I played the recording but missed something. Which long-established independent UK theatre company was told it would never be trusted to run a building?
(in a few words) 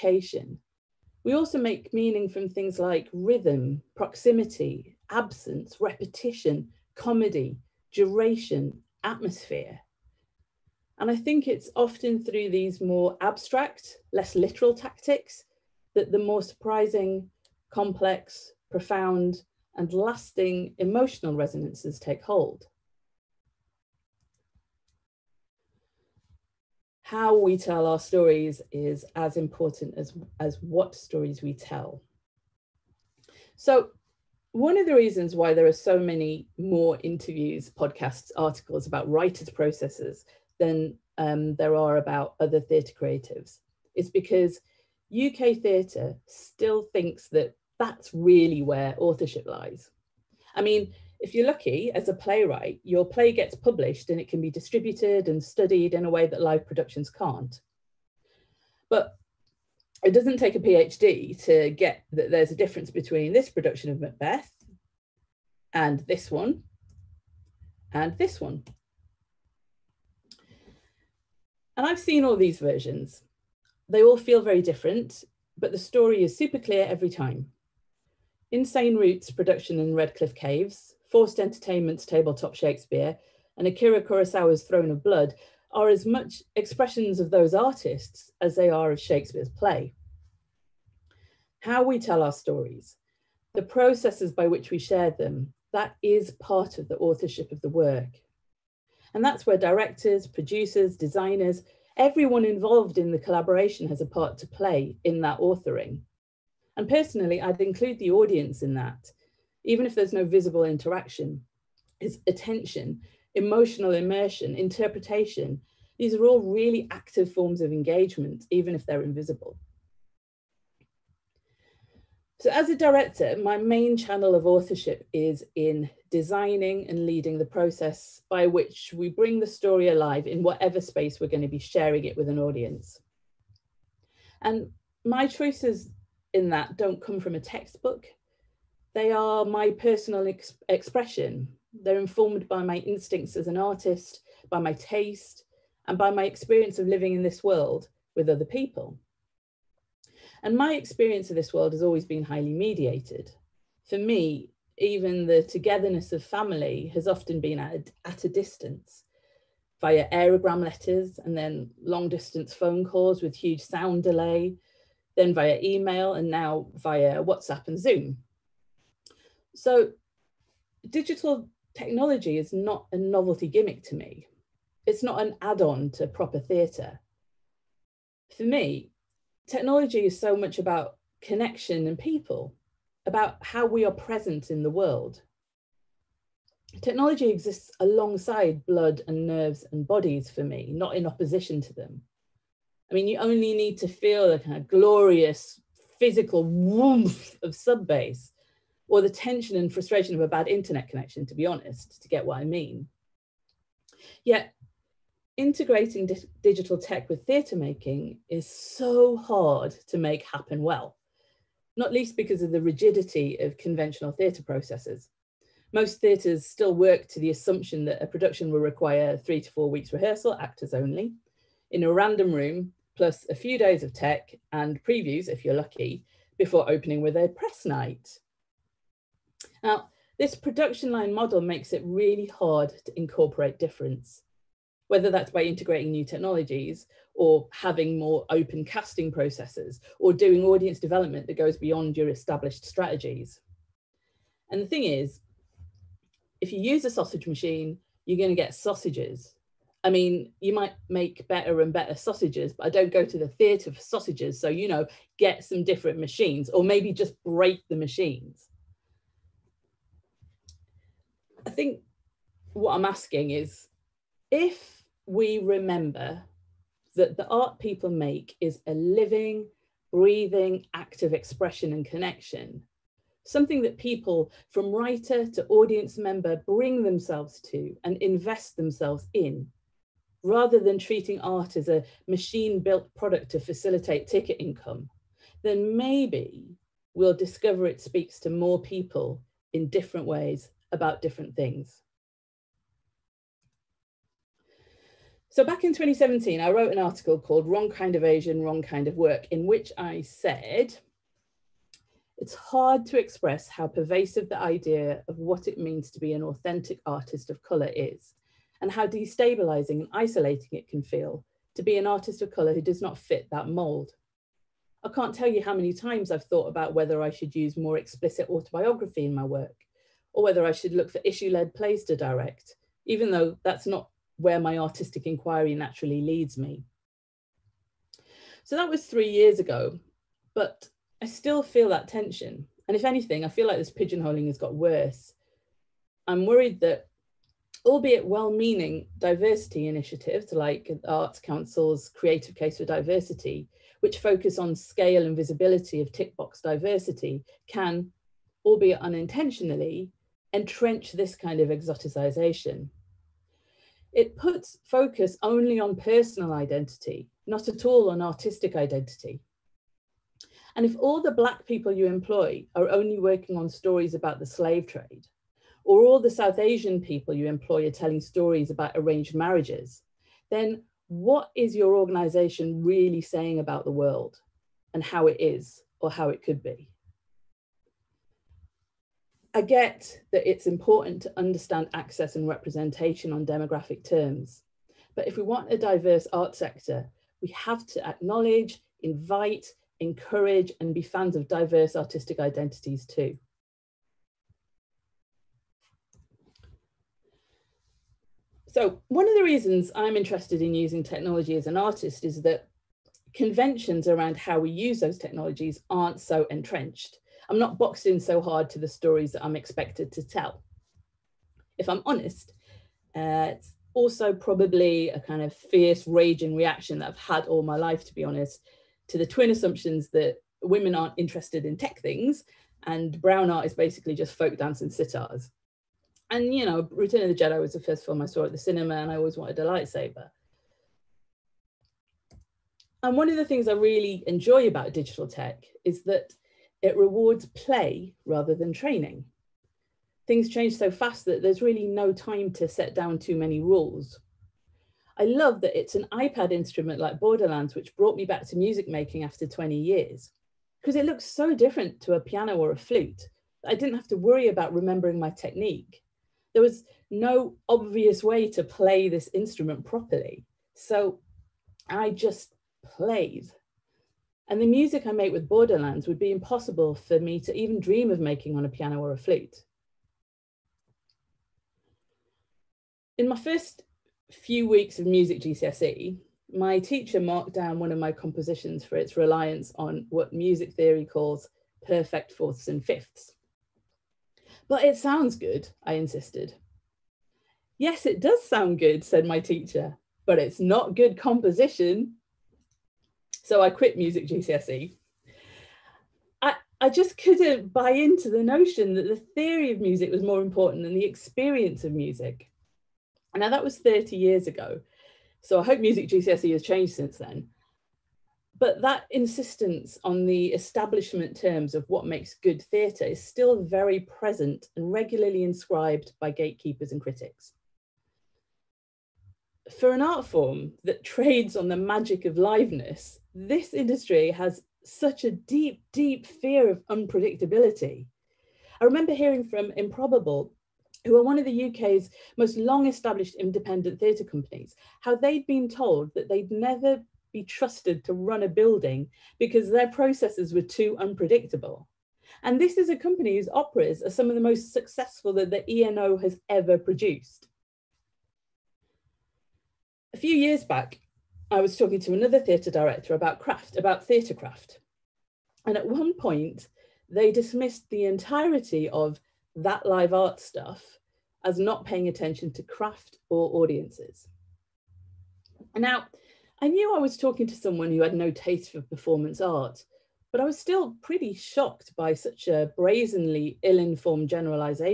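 Improbable.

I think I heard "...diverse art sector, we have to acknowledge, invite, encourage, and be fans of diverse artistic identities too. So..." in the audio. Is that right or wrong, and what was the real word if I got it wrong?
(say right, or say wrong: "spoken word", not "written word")
right.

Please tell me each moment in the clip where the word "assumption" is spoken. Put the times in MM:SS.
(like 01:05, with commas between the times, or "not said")
03:37, 06:59.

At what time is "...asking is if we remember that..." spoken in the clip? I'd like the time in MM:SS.
04:22.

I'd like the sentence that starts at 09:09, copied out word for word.
A few years back, I was talking to another theatre director about craft, about theatre craft.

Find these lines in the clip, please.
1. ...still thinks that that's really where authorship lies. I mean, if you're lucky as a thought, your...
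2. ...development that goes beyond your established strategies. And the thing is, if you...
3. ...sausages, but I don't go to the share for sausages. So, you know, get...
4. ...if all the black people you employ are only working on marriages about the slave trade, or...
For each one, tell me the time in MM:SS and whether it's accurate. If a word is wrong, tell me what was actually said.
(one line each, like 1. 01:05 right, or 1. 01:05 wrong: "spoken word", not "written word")
1. 00:46 wrong: "playwright", not "thought"
2. 04:00 right
3. 04:11 wrong: "theatre", not "share"
4. 06:00 wrong: "stories", not "marriages".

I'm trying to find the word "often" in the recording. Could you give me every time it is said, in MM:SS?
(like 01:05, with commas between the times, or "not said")
00:11, 02:37.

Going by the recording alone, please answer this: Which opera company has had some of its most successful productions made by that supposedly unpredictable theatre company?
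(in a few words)
ENO.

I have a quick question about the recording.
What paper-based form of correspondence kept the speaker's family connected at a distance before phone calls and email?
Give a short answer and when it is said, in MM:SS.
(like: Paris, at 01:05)
Aerogram letters, at 02:40.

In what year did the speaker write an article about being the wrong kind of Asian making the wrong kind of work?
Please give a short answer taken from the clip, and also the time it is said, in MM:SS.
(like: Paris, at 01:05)
2017, at 04:55.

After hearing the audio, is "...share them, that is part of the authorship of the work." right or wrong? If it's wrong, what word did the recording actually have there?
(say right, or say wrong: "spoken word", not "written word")
right.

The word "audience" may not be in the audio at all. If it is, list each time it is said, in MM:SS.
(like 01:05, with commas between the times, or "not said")
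01:48, 02:12, 04:00, 04:35, 09:23.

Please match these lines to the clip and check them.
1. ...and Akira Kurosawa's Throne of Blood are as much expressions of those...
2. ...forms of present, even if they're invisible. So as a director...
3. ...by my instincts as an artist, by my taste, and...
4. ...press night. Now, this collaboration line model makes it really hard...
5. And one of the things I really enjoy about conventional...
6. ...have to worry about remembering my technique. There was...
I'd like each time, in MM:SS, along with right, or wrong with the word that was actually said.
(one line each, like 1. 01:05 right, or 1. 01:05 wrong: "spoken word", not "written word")
1. 01:23 right
2. 01:57 wrong: "engagement", not "present"
3. 02:22 right
4. 03:47 wrong: "production", not "collaboration"
5. 07:12 wrong: "digital", not "conventional"
6. 07:33 right.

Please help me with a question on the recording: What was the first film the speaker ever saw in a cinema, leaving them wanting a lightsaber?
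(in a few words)
Return of the Jedi.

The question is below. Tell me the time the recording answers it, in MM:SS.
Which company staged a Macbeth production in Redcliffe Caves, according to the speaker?
01:18.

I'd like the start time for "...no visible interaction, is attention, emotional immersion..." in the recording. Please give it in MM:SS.
01:50.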